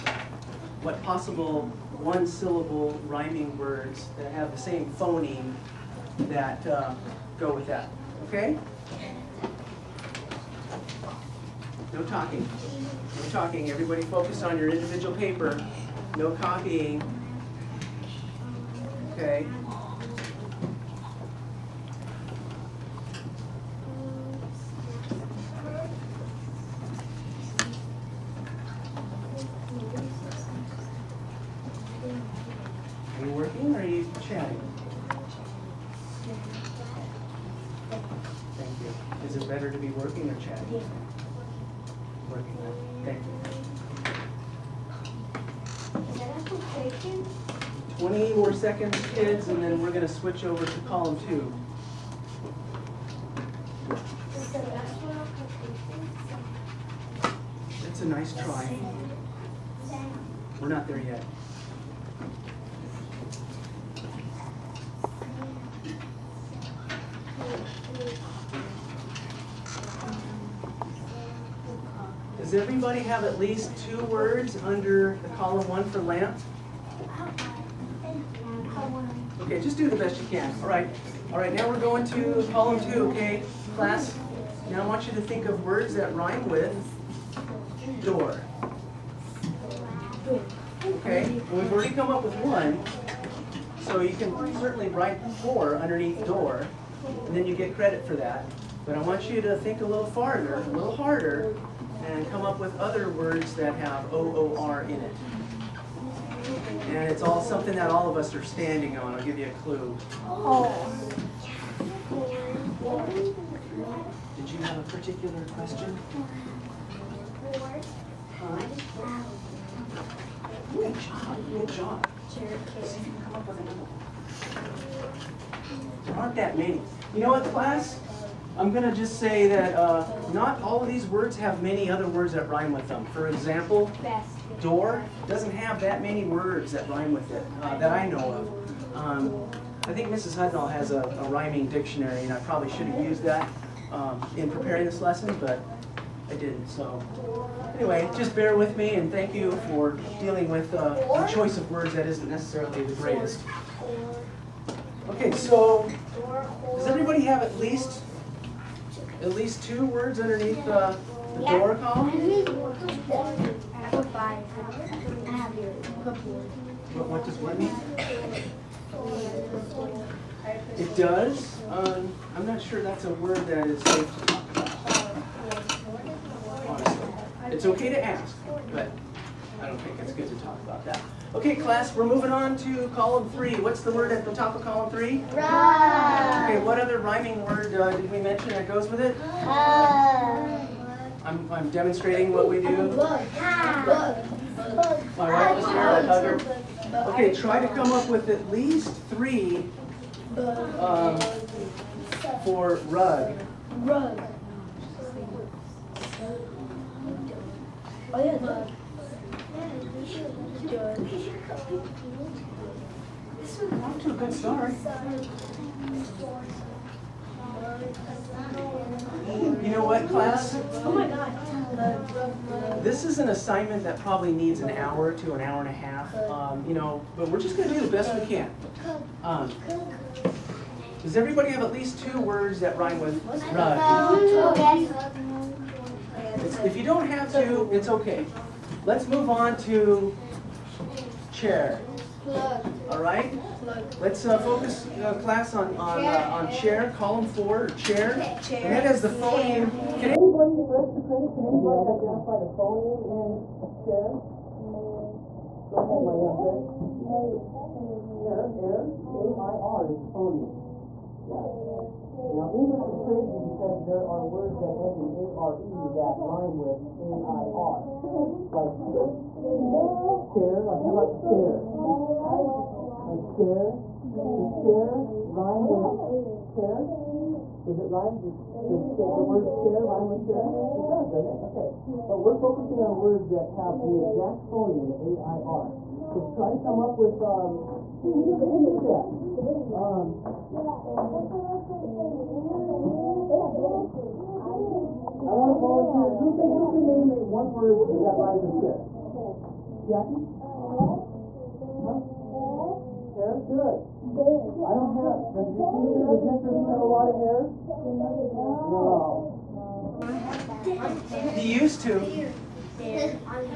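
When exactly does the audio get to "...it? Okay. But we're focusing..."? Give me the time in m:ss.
4:41.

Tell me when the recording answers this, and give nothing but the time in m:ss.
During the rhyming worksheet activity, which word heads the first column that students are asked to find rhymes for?
1:15.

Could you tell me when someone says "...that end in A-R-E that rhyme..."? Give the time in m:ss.
4:24.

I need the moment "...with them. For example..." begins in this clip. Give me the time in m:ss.
2:12.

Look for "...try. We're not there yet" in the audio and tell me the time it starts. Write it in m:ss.
0:58.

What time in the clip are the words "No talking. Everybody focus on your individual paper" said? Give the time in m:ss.
0:13.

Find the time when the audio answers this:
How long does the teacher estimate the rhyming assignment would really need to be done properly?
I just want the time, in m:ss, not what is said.
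3:44.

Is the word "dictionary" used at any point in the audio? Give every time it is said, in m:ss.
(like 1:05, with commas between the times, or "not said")
2:21.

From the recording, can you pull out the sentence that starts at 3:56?
If you don't have to, it's okay.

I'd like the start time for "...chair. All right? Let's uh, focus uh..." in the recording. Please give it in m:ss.
4:01.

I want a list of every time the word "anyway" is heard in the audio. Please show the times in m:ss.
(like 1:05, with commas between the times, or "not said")
2:27.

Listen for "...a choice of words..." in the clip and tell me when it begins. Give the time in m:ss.
2:31.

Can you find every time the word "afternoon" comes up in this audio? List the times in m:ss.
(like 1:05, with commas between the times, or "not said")
not said.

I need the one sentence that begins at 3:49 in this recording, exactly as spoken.
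Um, does everybody have at least two words that rhyme with rug?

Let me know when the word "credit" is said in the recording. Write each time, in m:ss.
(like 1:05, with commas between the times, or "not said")
1:37, 4:11.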